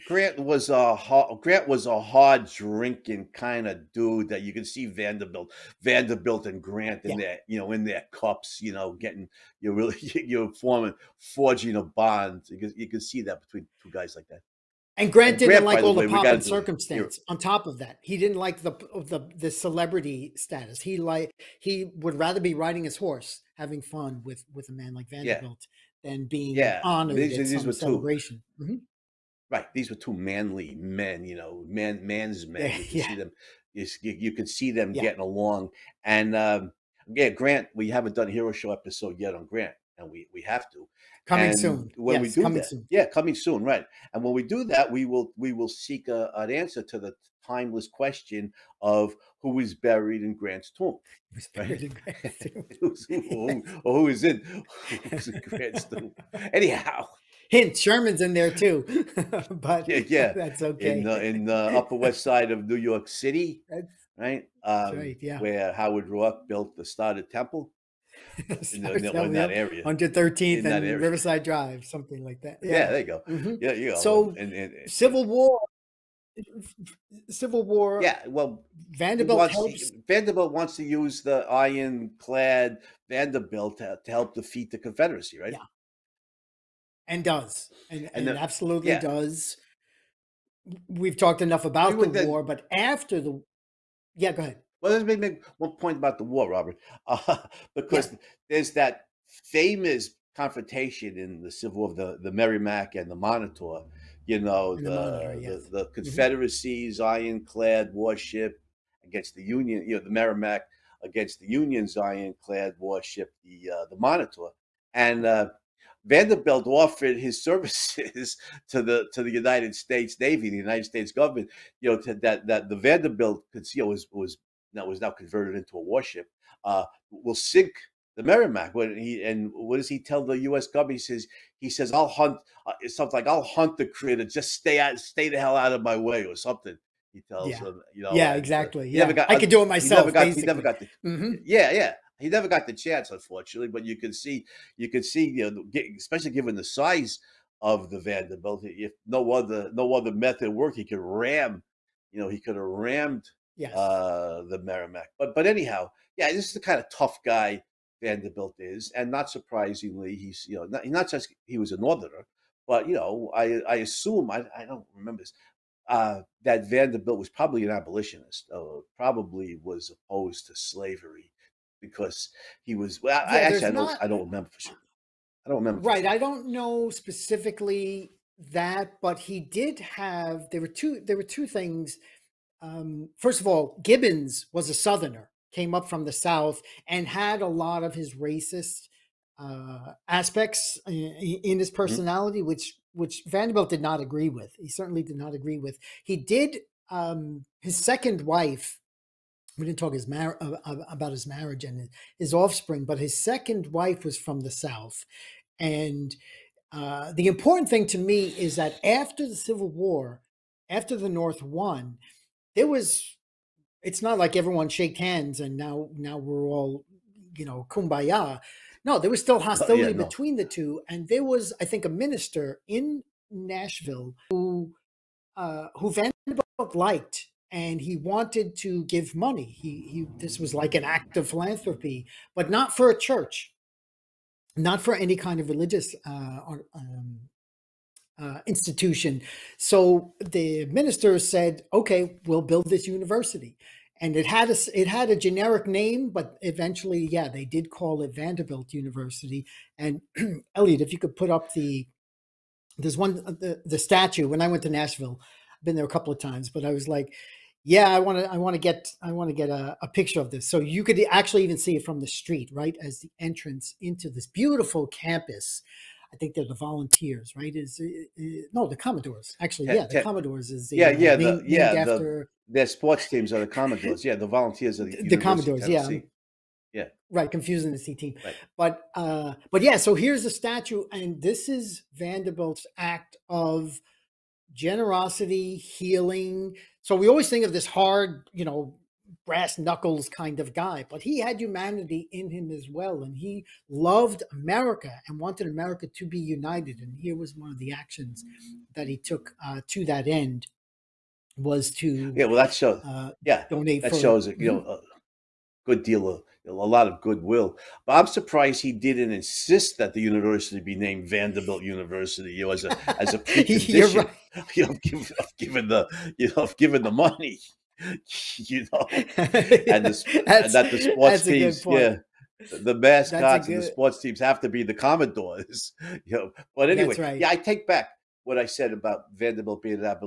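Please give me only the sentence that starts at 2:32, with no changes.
You know, he could have rammed yes.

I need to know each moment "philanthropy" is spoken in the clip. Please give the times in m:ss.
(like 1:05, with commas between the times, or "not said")
3:51.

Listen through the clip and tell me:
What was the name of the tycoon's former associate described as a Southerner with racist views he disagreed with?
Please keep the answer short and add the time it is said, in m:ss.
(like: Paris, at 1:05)
Gibbons, at 3:03.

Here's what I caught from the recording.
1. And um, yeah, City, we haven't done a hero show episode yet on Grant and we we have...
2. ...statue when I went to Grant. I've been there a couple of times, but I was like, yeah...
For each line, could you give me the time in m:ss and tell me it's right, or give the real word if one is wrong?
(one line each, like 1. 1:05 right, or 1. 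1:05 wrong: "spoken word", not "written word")
1. 0:36 wrong: "Grant", not "City"
2. 4:13 wrong: "Nashville", not "Grant".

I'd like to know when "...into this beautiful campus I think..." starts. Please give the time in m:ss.
4:23.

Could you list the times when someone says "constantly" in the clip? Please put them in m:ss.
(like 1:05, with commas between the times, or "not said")
not said.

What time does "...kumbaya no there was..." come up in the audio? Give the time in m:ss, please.
3:37.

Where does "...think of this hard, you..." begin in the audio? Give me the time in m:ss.
4:47.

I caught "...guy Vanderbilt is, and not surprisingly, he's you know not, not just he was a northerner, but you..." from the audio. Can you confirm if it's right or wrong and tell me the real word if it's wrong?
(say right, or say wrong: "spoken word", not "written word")
right.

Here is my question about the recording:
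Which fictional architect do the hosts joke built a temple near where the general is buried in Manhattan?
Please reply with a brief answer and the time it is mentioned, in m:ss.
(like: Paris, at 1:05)
Howard Roark, at 1:05.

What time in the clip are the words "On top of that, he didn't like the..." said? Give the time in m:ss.
0:17.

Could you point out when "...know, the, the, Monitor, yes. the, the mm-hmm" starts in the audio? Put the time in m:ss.
1:44.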